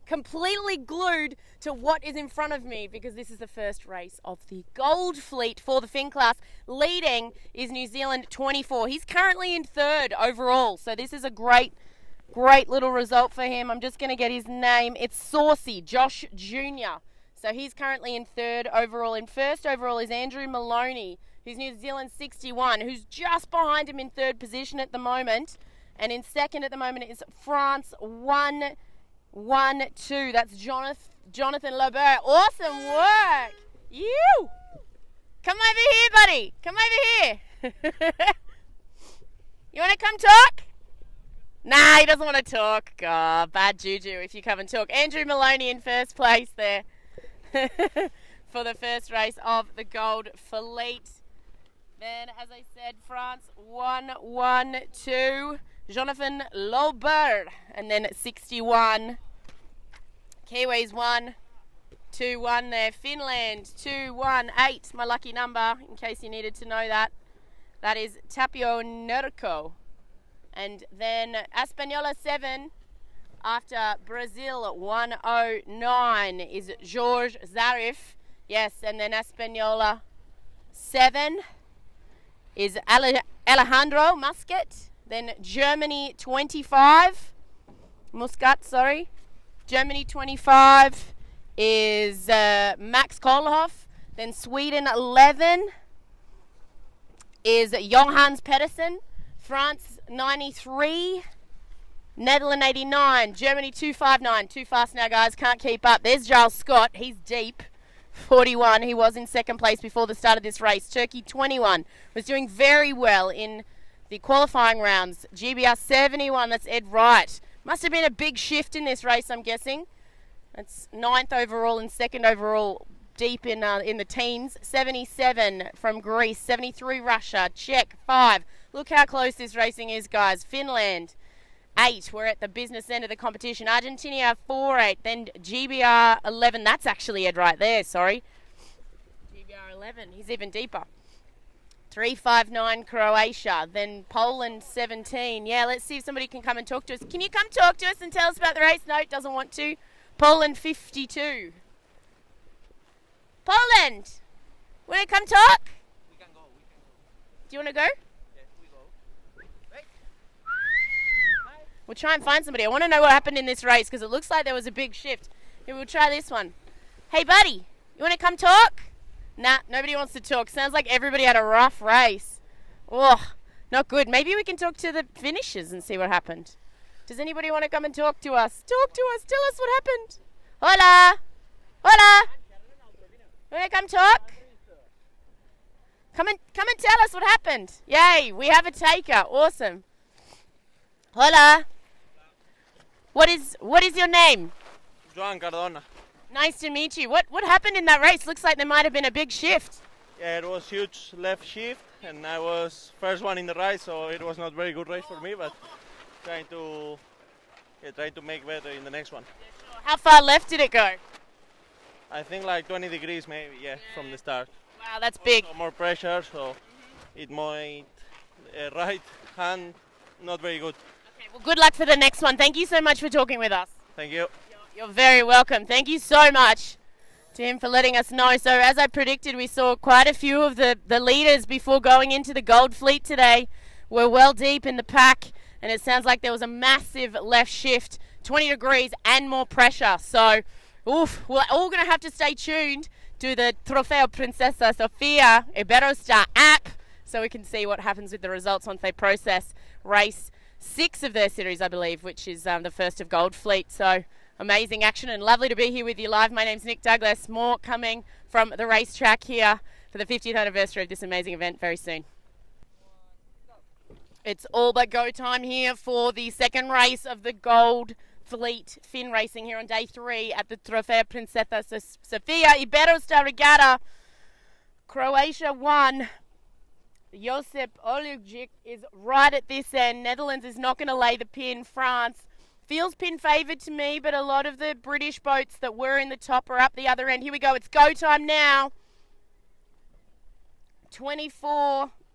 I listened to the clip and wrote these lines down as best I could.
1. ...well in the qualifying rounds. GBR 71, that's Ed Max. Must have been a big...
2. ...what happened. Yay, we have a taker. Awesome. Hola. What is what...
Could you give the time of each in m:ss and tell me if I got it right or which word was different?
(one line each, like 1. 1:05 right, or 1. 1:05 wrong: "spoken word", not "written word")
1. 1:52 wrong: "Wright", not "Max"
2. 3:07 right.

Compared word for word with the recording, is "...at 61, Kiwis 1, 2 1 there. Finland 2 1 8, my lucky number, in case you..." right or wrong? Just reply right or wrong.
right.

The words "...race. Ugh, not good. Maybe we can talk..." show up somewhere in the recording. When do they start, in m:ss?
2:51.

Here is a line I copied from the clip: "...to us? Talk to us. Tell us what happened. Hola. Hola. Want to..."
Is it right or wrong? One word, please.
right.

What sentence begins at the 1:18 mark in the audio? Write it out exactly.
Yes, and then Espanola 7 is Alejandro Musket.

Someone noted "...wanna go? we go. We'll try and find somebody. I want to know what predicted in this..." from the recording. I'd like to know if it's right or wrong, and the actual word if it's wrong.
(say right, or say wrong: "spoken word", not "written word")
wrong: "happened", not "predicted".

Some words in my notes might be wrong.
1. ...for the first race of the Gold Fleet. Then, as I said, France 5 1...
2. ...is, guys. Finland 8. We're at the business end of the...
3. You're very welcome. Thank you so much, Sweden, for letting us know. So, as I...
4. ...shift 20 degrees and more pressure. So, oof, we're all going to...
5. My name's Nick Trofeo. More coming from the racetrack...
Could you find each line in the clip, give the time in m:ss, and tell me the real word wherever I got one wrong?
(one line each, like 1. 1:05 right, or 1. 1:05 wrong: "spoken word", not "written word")
1. 0:48 wrong: "1", not "5"
2. 2:09 right
3. 3:44 wrong: "Tim", not "Sweden"
4. 3:57 right
5. 4:16 wrong: "Douglas", not "Trofeo".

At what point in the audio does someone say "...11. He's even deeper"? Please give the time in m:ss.
2:19.